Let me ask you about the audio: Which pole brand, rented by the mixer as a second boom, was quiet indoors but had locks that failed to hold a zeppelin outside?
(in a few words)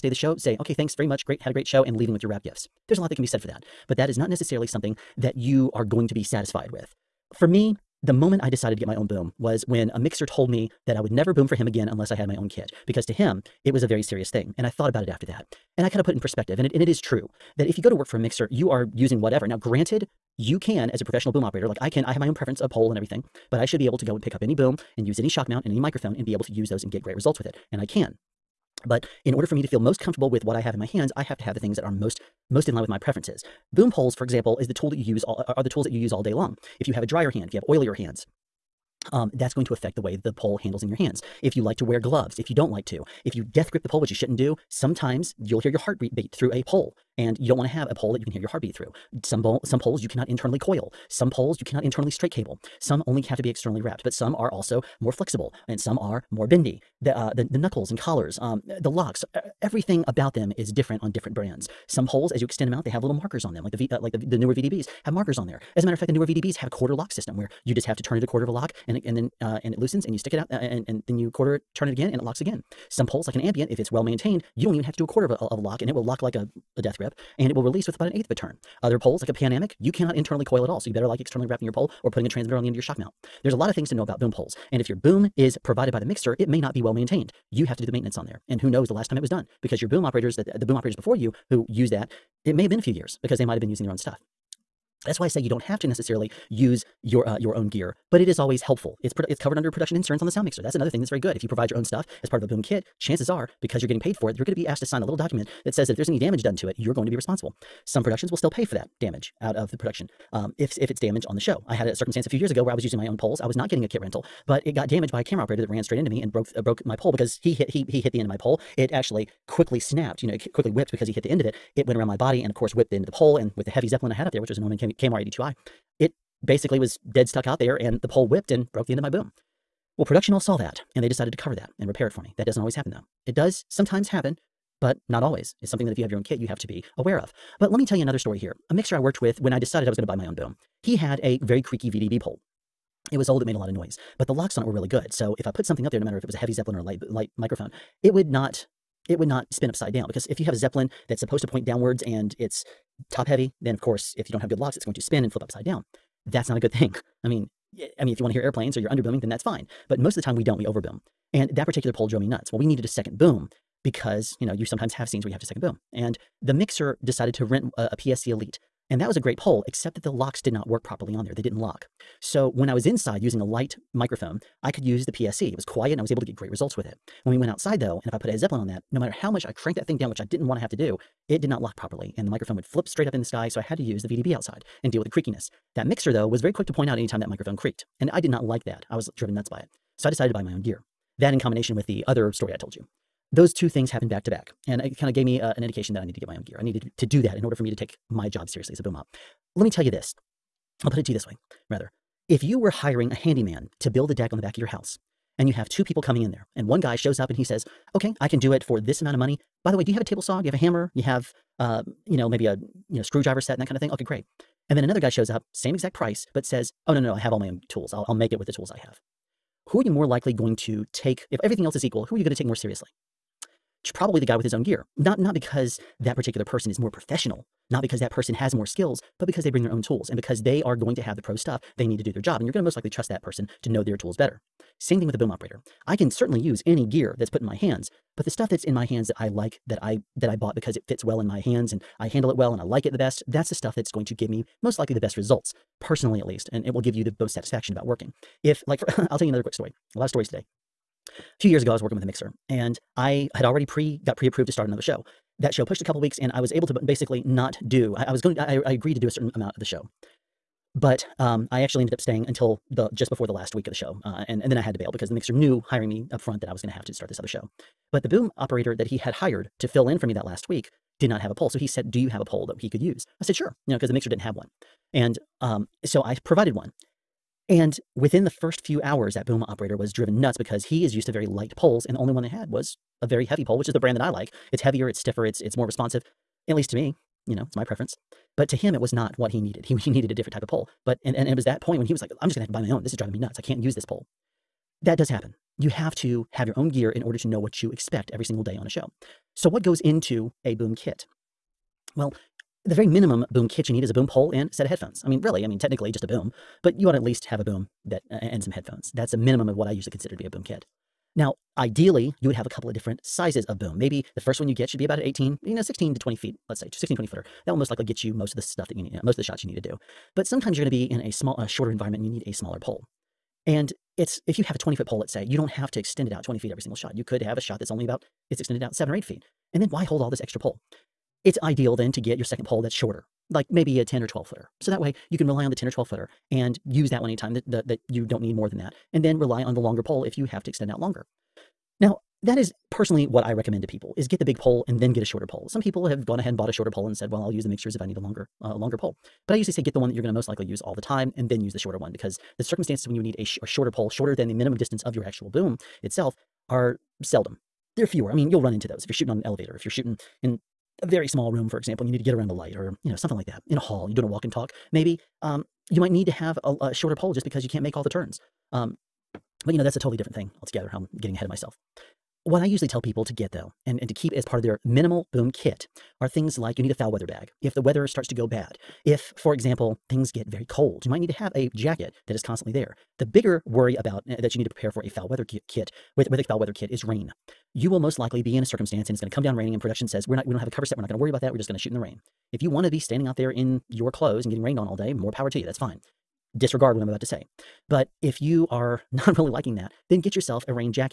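PSC Elite.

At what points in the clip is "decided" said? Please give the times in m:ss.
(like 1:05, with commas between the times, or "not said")
0:08, 2:11, 2:19, 2:47, 3:10.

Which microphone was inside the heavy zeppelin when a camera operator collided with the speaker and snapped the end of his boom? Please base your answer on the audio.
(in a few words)
Neumann KMR 82i.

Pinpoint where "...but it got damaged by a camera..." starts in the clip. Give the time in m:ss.
1:54.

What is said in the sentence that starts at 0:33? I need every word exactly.
Boom poles, for example, is the tool that you use all, uh, are the tools that you use all day long.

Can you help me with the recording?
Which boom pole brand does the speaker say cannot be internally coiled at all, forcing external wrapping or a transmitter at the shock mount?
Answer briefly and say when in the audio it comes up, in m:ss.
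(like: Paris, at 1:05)
Panamic, at 1:19.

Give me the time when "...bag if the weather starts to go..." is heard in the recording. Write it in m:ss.
6:17.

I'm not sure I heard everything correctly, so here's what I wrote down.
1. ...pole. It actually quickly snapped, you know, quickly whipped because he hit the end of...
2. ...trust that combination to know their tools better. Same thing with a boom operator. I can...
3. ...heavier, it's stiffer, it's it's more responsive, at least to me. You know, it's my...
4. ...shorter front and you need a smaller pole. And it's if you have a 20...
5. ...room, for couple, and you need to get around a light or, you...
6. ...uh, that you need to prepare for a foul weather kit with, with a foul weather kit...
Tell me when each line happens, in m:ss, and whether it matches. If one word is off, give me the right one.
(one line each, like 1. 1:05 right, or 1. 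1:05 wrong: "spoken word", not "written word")
1. 1:58 right
2. 3:52 wrong: "person", not "combination"
3. 4:44 right
4. 5:21 wrong: "environment", not "front"
5. 6:01 wrong: "example", not "couple"
6. 6:24 right.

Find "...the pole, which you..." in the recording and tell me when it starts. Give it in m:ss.
0:43.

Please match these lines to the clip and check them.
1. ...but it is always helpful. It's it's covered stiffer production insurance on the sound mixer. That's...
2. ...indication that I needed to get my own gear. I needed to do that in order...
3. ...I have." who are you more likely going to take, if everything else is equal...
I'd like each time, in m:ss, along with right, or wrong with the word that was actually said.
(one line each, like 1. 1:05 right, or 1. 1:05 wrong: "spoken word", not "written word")
1. 1:38 wrong: "under", not "stiffer"
2. 3:15 right
3. 3:38 right.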